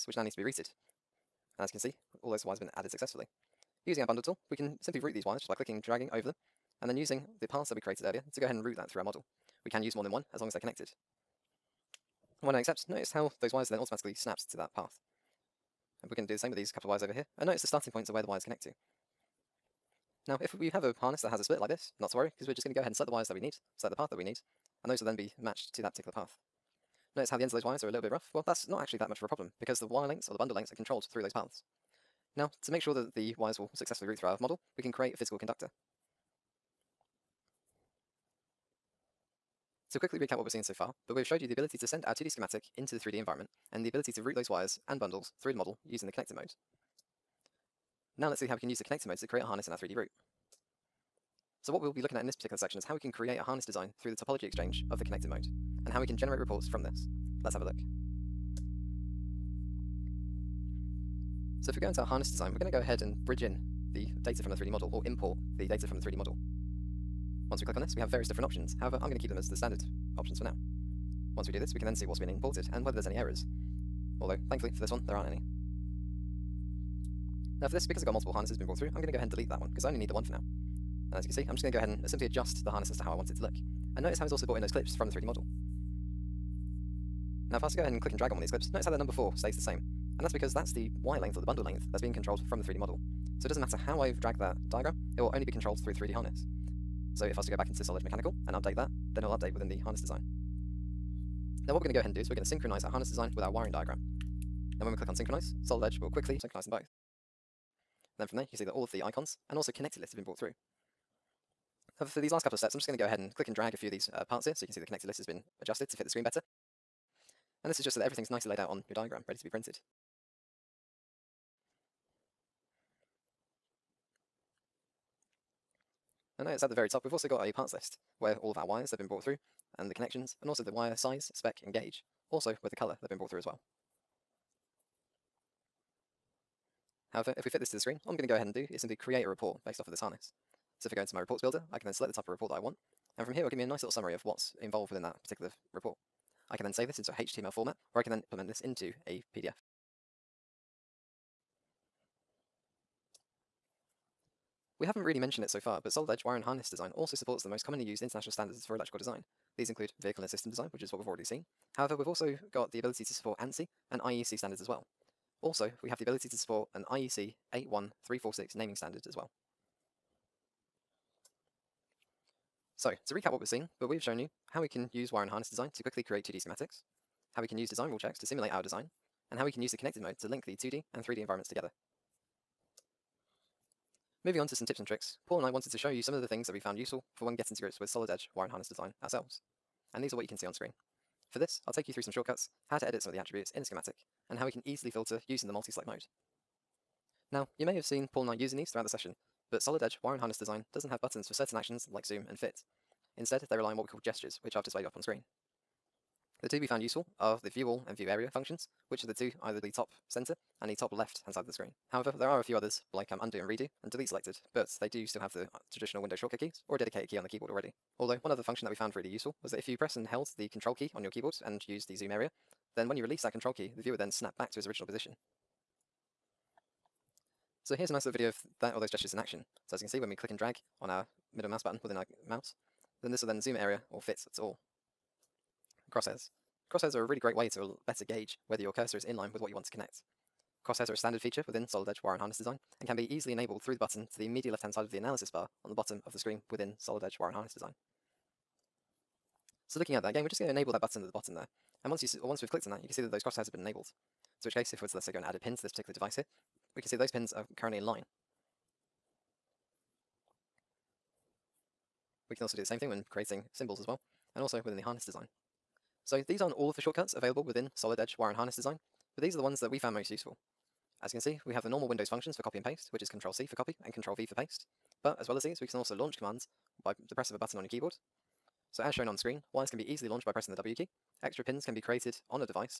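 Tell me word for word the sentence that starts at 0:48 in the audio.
Now let's see how we can use the connected modes to create a harness in our 3D route.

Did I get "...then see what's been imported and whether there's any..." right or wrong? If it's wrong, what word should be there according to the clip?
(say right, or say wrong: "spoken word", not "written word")
right.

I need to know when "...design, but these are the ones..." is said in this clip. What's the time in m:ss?
4:28.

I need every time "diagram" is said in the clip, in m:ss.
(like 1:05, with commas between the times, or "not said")
1:34, 1:43, 1:58.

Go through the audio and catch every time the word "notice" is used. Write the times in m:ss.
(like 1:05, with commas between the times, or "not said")
0:12, 0:17, 0:27, 1:24, 1:28.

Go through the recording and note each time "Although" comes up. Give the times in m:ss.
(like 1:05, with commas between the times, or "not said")
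1:14, 3:38.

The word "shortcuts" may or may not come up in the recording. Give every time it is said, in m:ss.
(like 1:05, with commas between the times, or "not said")
3:12, 3:36, 4:26.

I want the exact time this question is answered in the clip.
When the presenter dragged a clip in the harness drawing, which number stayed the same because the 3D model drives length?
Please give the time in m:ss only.
1:28.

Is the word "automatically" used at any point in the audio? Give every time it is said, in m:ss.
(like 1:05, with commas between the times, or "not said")
0:13.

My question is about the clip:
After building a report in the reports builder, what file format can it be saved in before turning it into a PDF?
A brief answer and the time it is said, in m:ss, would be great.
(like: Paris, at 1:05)
HTML, at 2:27.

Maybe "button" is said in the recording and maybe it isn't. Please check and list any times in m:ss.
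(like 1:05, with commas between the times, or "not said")
3:21, 3:51, 4:03, 4:10, 4:37.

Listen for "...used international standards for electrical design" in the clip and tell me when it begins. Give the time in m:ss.
2:37.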